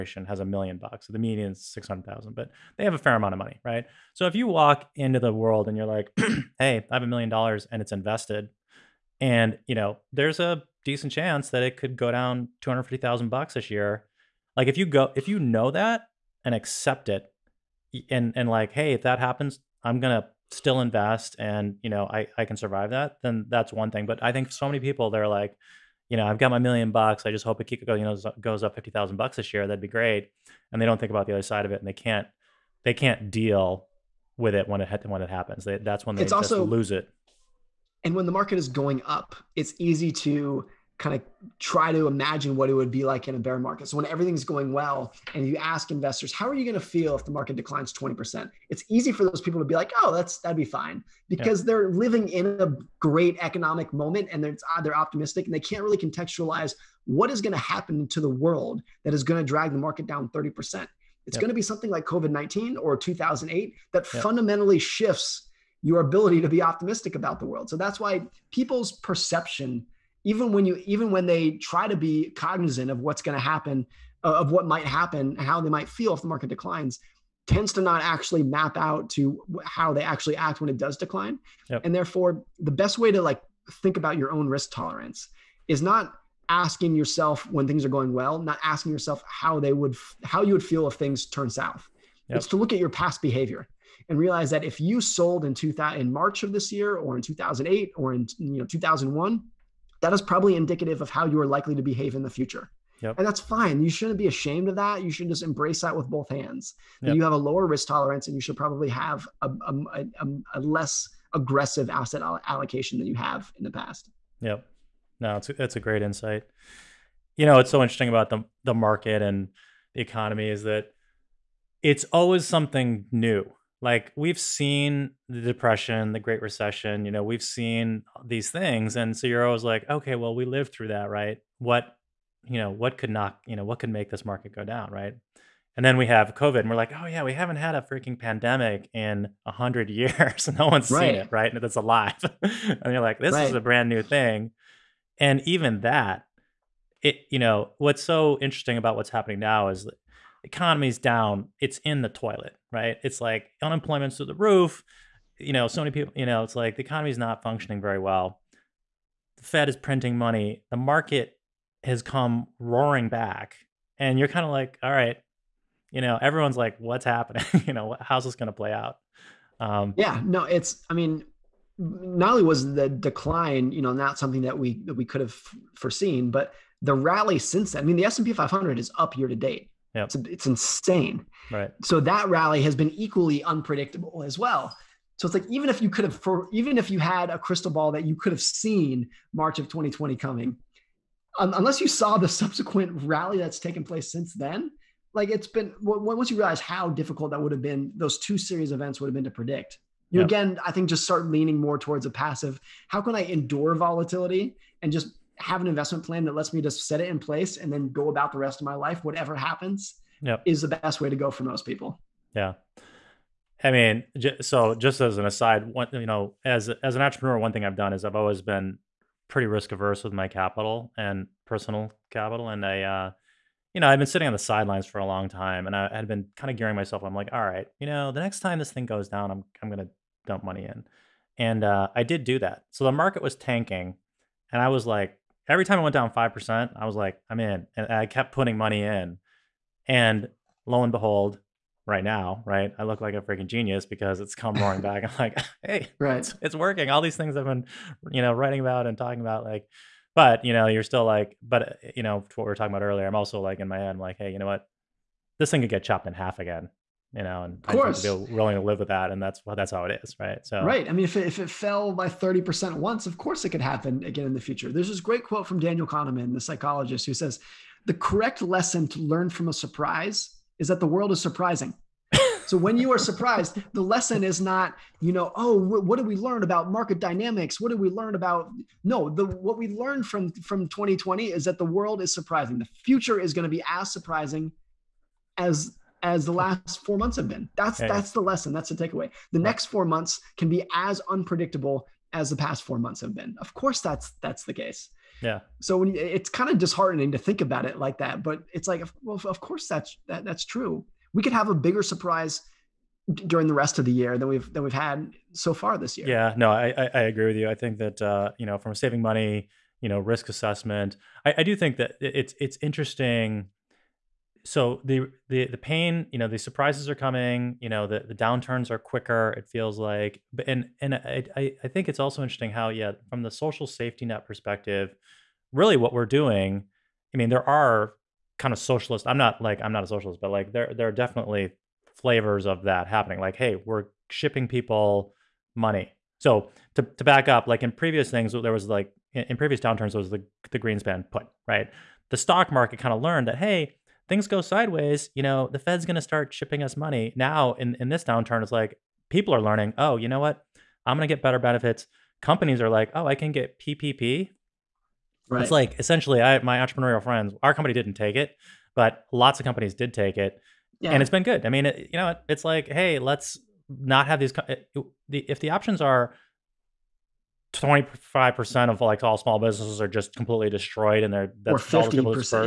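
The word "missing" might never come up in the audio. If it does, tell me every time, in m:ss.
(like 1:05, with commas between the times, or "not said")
not said.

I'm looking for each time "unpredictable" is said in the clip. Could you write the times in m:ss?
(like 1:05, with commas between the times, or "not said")
3:03, 4:51.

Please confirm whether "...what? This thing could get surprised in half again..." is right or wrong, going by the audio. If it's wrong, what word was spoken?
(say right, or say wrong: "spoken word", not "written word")
wrong: "chopped", not "surprised".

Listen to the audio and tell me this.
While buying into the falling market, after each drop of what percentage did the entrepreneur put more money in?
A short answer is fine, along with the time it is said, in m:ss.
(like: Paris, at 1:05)
5%, at 3:56.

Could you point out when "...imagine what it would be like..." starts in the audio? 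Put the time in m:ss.
0:42.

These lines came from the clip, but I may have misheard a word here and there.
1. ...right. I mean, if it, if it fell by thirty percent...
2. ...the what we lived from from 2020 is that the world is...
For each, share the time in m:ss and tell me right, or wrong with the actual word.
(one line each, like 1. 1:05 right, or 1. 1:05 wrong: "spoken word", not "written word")
1. 4:20 right
2. 4:39 wrong: "learned", not "lived".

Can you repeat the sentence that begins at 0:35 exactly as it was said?
They, that's when they it's also, lose it.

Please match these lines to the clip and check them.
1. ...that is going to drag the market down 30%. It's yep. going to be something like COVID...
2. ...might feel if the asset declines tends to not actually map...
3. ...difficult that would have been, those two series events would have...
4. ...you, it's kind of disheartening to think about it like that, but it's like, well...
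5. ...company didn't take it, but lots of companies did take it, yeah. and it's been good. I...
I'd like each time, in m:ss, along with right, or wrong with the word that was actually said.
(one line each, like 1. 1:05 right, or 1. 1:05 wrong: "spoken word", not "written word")
1. 0:59 right
2. 1:15 wrong: "market", not "asset"
3. 3:16 right
4. 4:55 right
5. 5:57 right.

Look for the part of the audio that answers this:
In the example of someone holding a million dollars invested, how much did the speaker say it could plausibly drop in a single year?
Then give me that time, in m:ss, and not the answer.
0:12.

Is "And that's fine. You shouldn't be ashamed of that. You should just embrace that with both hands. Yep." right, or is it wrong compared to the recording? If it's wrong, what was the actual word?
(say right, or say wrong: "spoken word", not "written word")
right.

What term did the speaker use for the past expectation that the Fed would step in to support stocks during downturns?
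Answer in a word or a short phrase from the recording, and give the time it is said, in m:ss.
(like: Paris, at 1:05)
Greenspan put, at 5:40.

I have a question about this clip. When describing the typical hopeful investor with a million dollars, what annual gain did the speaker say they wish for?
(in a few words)
$50,000.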